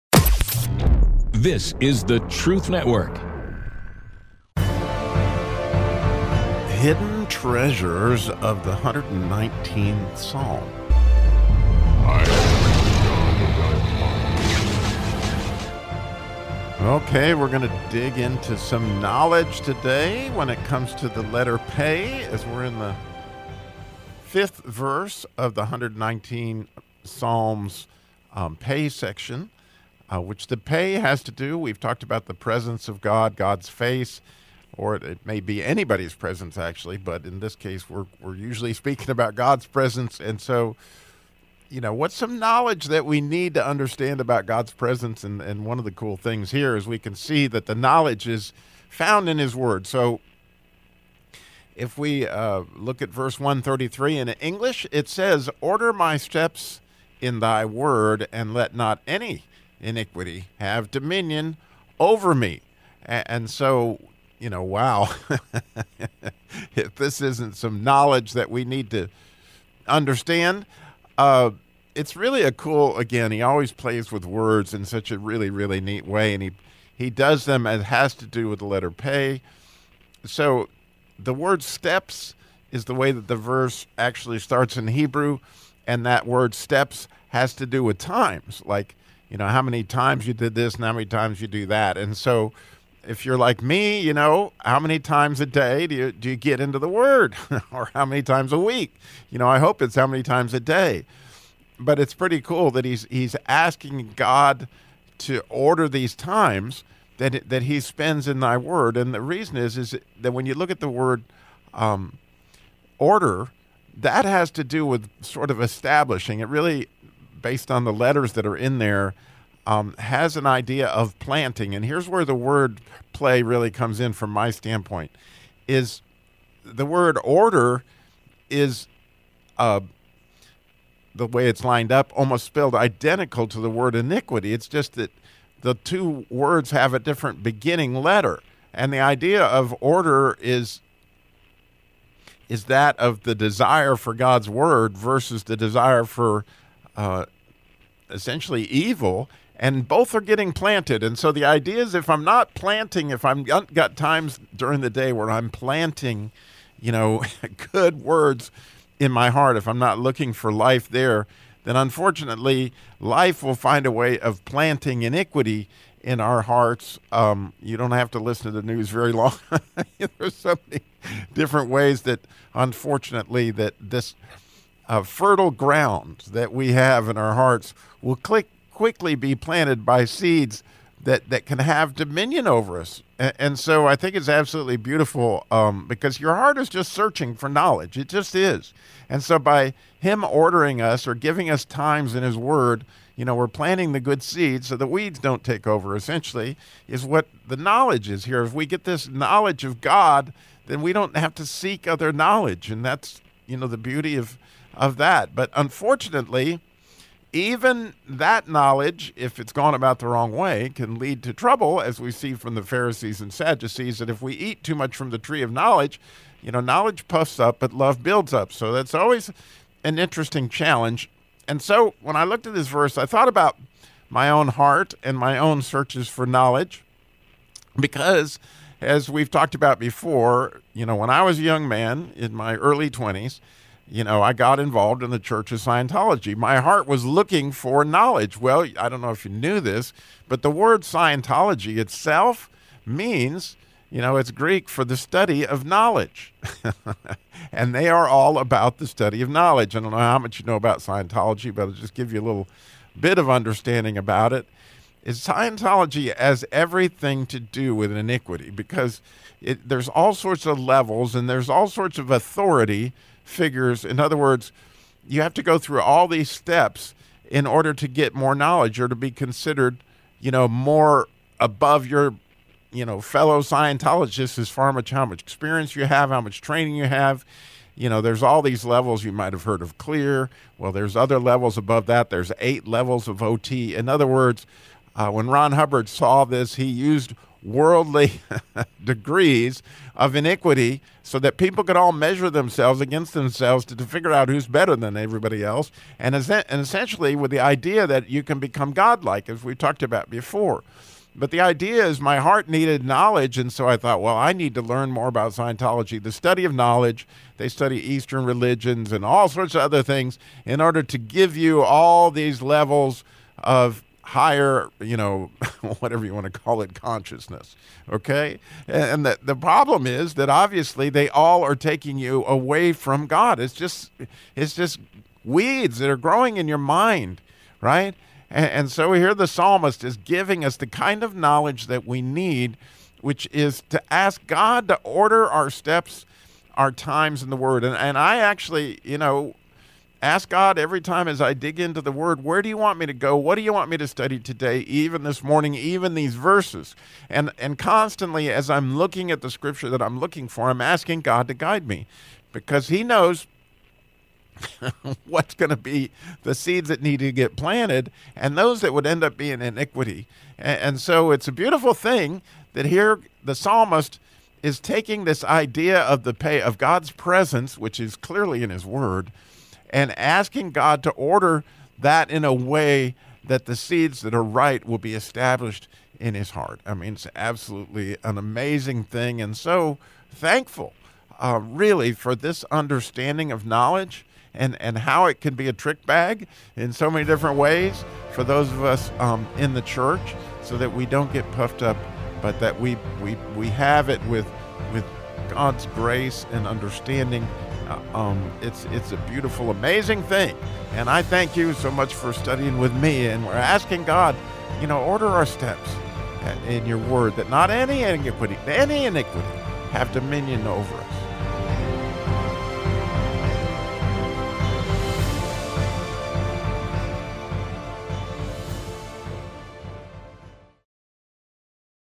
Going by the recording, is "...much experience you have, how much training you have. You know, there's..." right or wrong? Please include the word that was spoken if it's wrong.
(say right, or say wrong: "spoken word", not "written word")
right.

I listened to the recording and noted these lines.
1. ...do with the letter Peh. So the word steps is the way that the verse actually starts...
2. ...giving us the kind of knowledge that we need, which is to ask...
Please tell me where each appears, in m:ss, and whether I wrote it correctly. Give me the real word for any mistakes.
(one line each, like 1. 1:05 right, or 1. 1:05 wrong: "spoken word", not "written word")
1. 1:18 right
2. 5:29 right.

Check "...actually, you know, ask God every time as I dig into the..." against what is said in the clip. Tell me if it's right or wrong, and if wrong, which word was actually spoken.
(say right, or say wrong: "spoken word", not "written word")
right.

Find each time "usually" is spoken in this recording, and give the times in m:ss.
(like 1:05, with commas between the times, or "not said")
0:38.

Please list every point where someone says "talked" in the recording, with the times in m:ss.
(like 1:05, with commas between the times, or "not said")
0:31, 3:49, 4:59.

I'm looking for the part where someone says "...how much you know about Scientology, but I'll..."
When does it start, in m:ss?
4:09.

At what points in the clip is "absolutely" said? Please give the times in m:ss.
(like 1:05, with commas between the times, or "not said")
3:04, 6:17.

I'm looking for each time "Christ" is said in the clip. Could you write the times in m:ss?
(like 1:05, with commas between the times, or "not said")
not said.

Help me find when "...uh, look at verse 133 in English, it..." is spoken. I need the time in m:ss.
0:52.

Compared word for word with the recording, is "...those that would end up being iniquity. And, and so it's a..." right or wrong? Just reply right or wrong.
right.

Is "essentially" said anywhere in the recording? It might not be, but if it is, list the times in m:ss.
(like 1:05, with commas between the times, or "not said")
2:28, 3:15, 4:56.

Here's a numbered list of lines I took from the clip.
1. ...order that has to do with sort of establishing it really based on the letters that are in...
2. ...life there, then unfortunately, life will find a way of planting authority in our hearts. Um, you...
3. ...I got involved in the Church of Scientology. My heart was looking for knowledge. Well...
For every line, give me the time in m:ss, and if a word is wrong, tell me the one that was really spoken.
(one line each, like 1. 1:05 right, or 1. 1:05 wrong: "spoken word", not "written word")
1. 1:52 right
2. 2:40 wrong: "iniquity", not "authority"
3. 3:54 right.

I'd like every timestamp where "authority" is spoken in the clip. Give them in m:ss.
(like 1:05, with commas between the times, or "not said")
4:22.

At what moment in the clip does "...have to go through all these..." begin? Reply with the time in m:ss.
4:25.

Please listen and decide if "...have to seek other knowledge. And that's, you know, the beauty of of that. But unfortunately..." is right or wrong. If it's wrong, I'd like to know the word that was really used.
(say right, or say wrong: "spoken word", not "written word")
right.